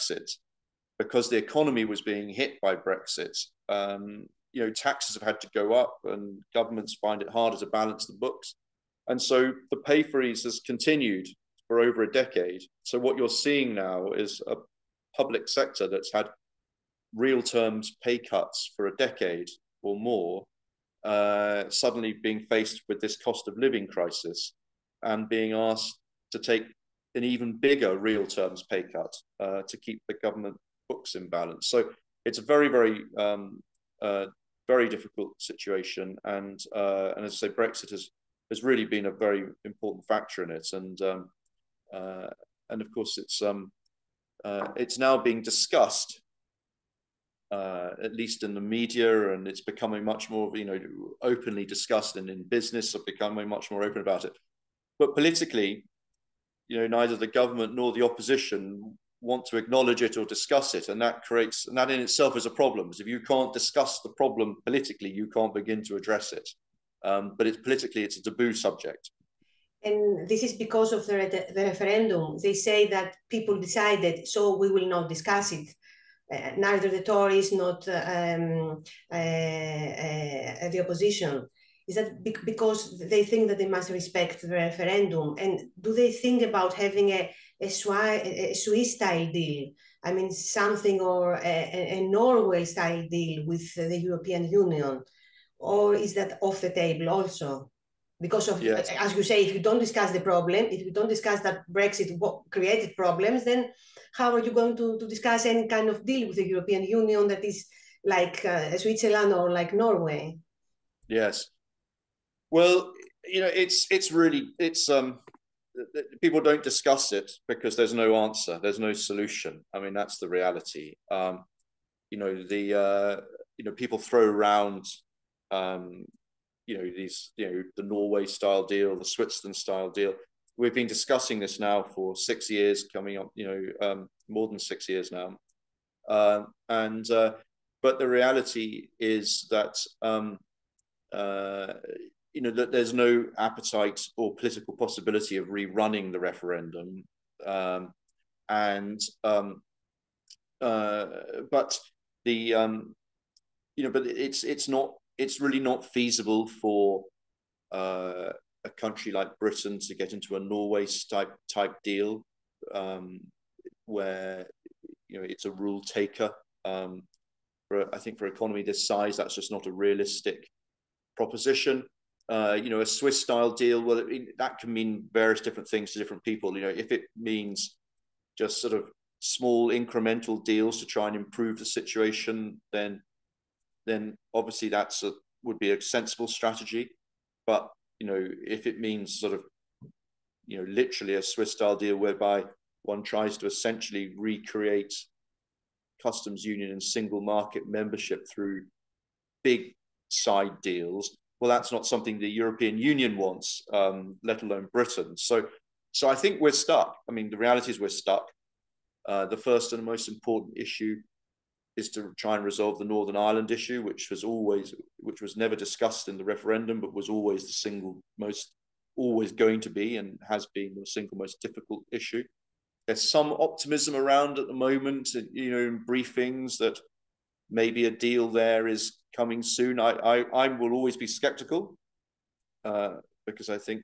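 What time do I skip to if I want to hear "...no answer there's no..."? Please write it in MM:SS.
01:57.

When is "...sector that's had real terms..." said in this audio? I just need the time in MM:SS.
00:15.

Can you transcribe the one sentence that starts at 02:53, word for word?
Well, it, that can mean various different things to different people.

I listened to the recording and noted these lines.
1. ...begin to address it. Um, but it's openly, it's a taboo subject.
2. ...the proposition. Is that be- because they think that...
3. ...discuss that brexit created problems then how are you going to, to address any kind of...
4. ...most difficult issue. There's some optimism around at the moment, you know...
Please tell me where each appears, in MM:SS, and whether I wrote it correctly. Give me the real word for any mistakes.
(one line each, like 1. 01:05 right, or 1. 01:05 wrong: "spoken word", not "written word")
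1. 01:05 wrong: "politically", not "openly"
2. 01:20 wrong: "opposition", not "proposition"
3. 01:41 wrong: "discuss", not "address"
4. 03:41 right.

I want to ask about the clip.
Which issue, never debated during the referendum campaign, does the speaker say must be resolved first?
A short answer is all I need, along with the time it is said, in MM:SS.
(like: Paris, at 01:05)
Northern Ireland, at 03:32.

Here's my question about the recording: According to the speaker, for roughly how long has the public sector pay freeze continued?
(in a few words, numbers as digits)
over a decade.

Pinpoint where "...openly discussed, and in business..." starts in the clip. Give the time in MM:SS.
00:51.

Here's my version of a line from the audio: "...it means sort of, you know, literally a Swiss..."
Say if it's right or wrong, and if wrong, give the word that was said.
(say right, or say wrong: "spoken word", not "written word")
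right.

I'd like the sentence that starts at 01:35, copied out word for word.
Or is that off the table also?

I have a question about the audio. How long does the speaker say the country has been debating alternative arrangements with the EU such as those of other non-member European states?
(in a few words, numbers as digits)
more than 6 years.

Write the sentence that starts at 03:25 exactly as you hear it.
So, so I think we're stuck.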